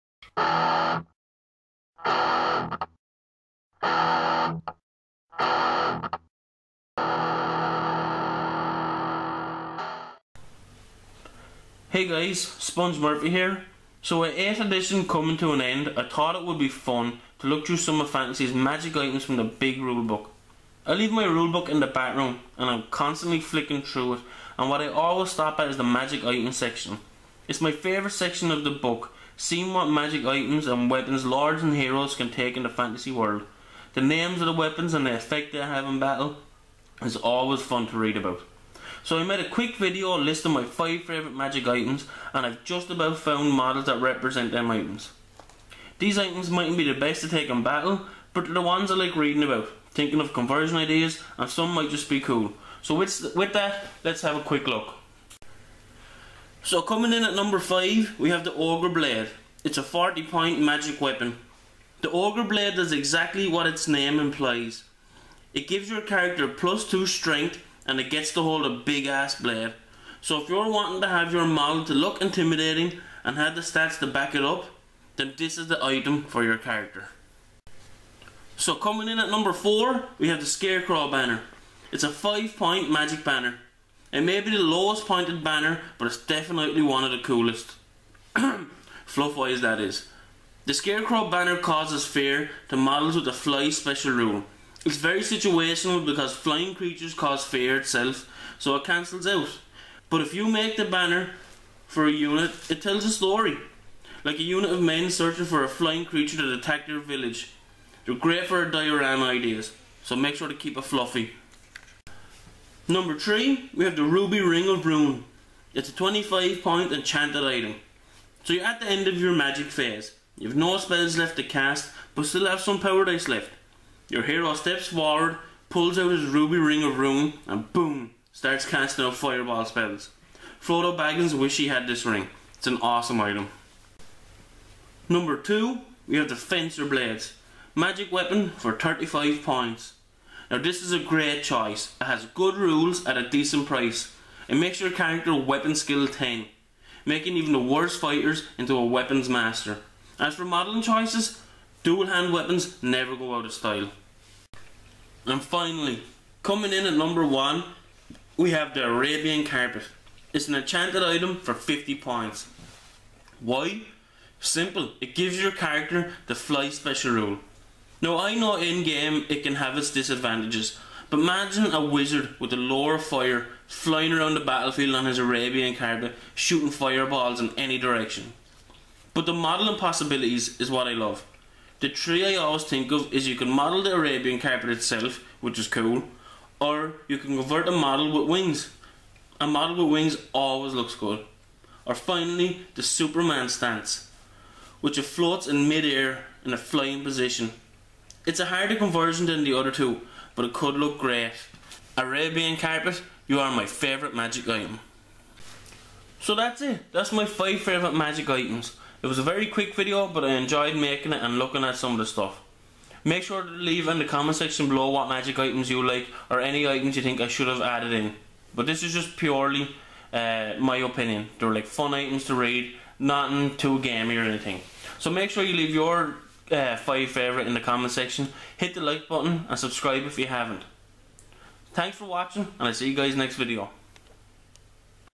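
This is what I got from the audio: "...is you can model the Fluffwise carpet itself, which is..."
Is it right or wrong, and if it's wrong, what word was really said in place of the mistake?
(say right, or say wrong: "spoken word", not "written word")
wrong: "Arabian", not "Fluffwise".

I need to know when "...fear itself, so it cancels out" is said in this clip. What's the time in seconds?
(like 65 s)
97 s.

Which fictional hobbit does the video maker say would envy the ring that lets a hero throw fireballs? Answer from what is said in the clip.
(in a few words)
Frodo Baggins.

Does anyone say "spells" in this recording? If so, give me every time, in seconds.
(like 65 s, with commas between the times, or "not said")
120 s, 129 s.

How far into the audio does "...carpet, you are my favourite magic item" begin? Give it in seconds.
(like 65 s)
202 s.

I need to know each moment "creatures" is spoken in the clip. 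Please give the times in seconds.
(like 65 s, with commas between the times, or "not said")
96 s, 106 s.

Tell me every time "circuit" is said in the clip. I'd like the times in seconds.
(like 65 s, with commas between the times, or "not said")
not said.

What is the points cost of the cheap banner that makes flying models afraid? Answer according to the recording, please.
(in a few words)
5.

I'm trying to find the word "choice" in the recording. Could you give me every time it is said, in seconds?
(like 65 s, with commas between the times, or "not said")
141 s, 150 s.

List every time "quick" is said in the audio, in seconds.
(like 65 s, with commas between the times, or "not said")
39 s, 54 s, 209 s.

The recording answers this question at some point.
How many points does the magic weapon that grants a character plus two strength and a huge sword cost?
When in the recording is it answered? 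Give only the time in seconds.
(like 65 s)
59 s.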